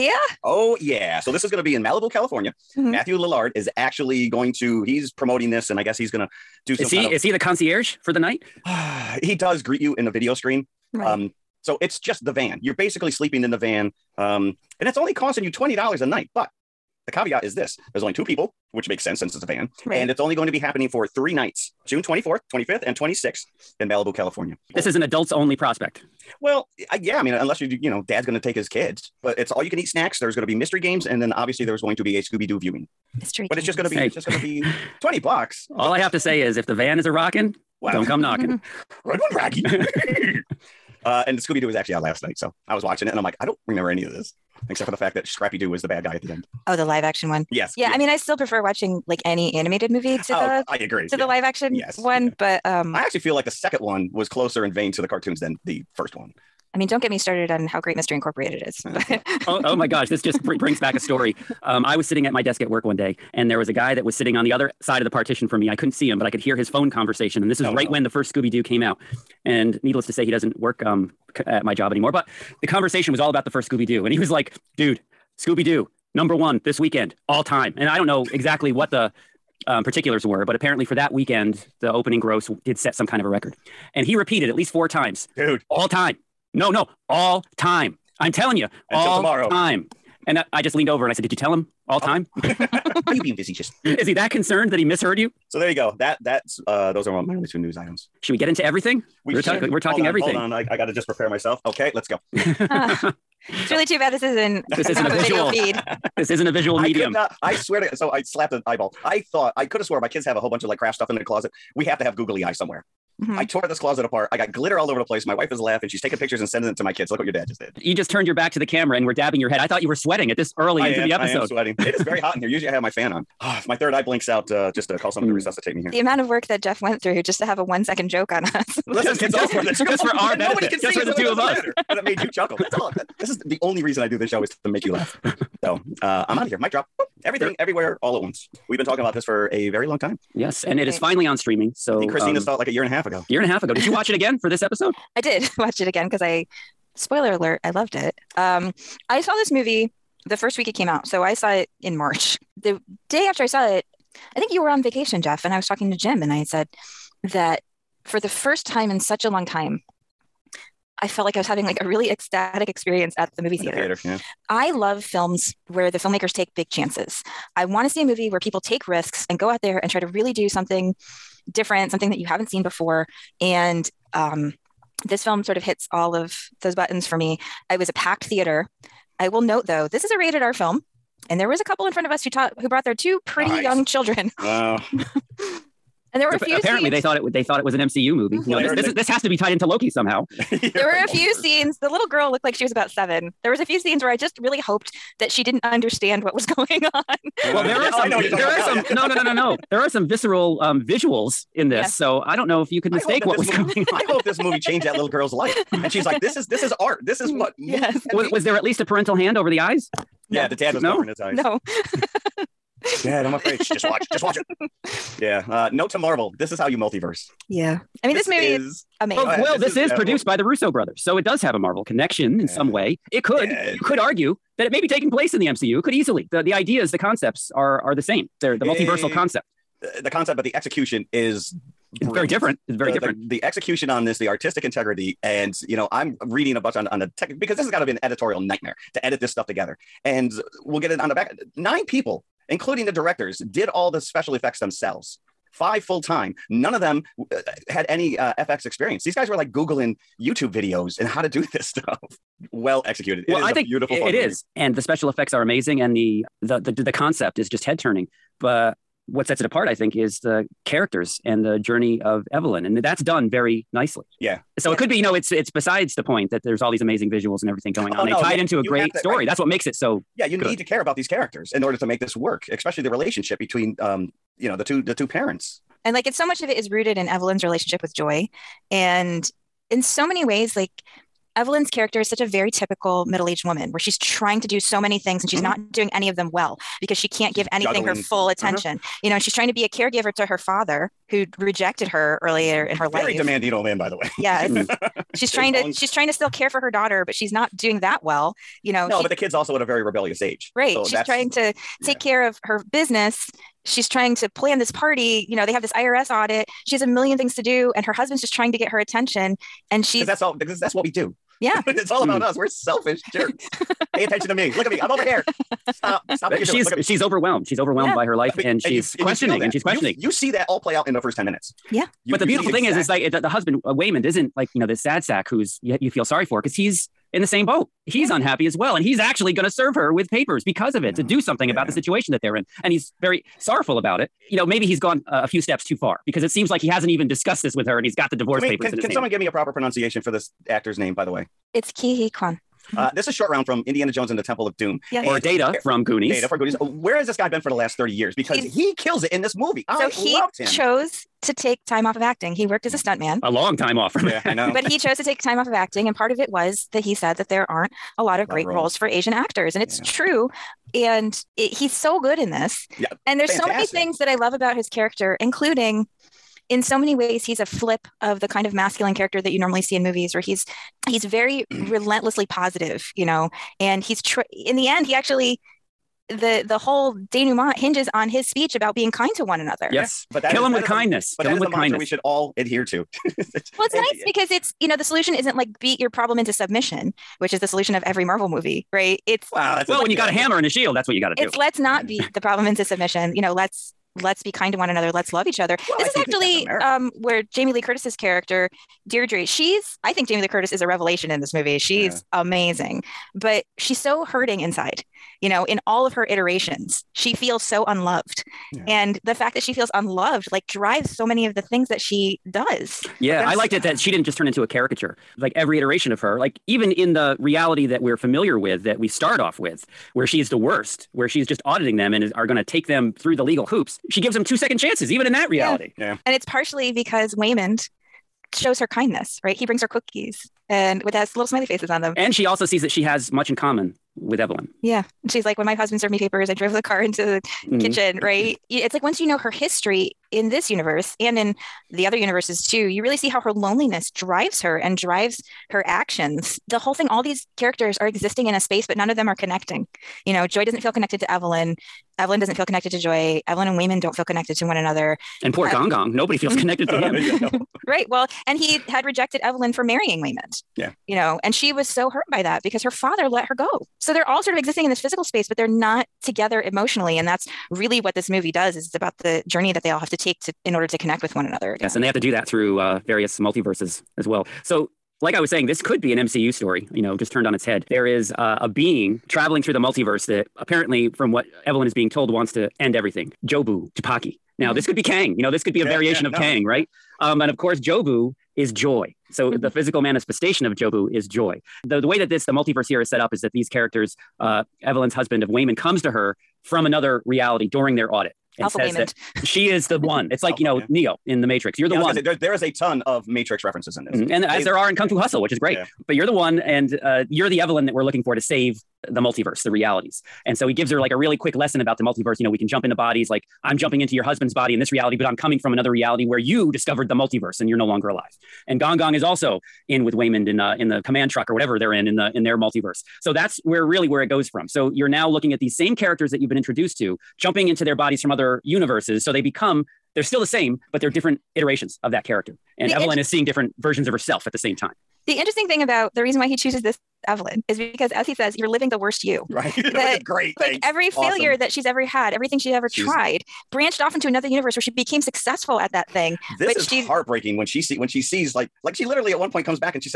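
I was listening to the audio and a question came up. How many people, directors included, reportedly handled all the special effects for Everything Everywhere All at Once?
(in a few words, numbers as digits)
9.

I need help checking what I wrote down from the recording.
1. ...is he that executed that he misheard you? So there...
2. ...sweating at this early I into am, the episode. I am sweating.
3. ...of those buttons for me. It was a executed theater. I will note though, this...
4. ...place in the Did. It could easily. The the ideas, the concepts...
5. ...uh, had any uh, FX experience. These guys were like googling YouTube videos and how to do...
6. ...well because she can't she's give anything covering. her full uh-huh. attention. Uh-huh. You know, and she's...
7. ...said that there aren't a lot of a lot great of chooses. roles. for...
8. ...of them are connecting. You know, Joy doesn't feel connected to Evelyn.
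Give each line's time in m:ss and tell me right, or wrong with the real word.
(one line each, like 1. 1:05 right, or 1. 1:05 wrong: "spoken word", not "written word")
1. 1:33 wrong: "concerned", not "executed"
2. 1:59 right
3. 2:56 wrong: "packed", not "executed"
4. 3:45 wrong: "MCU", not "Did"
5. 4:07 right
6. 4:46 wrong: "juggling", not "covering"
7. 5:56 wrong: "roles", not "chooses"
8. 7:28 right.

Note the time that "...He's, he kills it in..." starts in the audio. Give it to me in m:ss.
5:48.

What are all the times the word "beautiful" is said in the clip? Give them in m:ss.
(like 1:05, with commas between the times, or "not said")
4:13, 5:22.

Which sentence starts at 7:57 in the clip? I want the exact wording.
There is uh, a being traveling through the multiverse that apparently, from what Evelyn is being told wants to end everything.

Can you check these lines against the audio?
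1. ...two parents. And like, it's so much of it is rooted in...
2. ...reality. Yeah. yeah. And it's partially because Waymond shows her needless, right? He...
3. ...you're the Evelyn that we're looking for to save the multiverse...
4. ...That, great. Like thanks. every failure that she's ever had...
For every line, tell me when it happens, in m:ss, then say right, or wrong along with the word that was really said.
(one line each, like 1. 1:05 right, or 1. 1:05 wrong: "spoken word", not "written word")
1. 4:34 right
2. 7:05 wrong: "kindness", not "needless"
3. 8:27 right
4. 8:59 right.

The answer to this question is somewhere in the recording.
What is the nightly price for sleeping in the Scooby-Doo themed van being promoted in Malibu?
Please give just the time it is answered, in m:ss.
0:15.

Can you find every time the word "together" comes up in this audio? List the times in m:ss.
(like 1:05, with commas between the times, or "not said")
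3:59, 7:46.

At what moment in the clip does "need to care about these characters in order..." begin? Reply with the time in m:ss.
4:30.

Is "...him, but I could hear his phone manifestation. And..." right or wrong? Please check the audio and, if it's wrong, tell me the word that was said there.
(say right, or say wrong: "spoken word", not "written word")
wrong: "conversation", not "manifestation".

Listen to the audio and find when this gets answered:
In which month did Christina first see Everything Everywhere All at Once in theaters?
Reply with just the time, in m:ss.
2:31.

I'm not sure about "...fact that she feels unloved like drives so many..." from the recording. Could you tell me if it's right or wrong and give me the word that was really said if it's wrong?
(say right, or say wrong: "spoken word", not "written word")
right.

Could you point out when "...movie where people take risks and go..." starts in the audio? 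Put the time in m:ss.
2:48.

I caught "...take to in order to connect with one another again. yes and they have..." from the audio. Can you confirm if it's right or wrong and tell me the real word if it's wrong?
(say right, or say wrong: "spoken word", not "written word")
right.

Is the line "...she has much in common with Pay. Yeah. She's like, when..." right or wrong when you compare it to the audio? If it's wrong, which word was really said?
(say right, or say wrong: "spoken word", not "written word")
wrong: "Evelyn", not "Pay".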